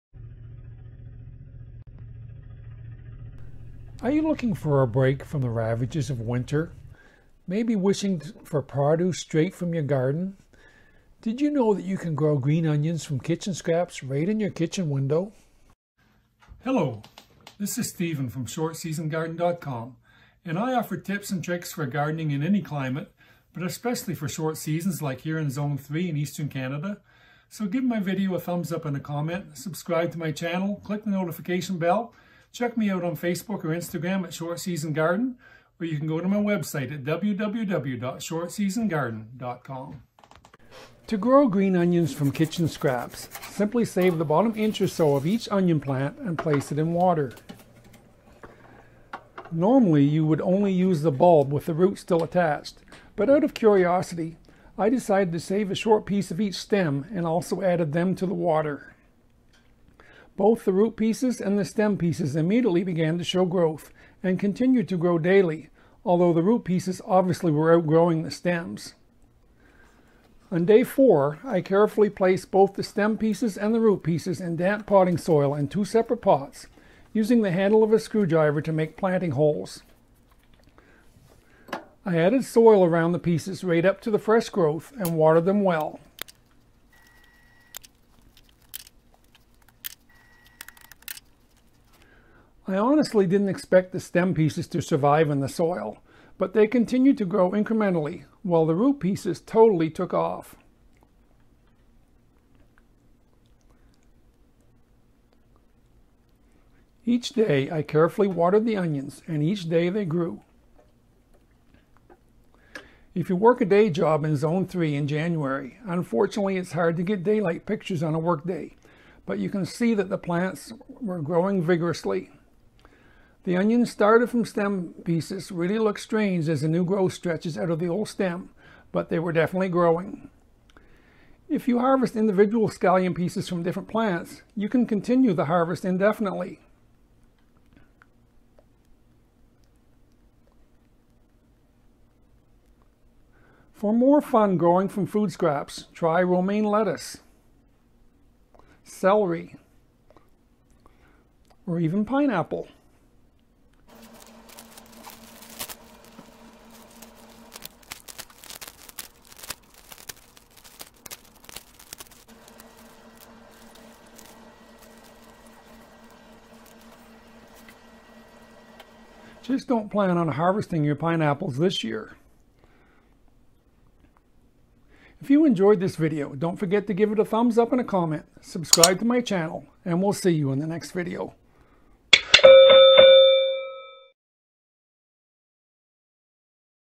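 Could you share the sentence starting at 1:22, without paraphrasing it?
I added soil around the pieces right up to the fresh growth and watered them well.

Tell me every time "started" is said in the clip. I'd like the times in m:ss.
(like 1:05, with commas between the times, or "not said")
2:03.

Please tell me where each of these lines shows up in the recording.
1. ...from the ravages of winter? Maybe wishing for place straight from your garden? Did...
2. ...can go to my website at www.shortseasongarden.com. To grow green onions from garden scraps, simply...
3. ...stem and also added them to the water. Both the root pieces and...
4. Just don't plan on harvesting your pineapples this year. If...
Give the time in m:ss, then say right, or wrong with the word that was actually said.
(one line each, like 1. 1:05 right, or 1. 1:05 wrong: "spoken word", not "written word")
1. 0:05 wrong: "produce", not "place"
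2. 0:35 wrong: "kitchen", not "garden"
3. 0:56 right
4. 2:49 right.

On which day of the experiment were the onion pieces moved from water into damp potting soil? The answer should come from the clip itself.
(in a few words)
Day four.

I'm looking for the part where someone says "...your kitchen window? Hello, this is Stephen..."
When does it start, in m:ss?
0:14.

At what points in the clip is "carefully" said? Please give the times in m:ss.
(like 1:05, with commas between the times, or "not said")
1:11, 1:47.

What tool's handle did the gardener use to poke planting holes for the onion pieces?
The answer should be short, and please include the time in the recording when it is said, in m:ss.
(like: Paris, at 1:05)
A screwdriver, at 1:17.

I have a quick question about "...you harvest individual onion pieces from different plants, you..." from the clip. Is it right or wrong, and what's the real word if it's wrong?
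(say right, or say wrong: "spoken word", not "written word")
wrong: "scallion", not "onion".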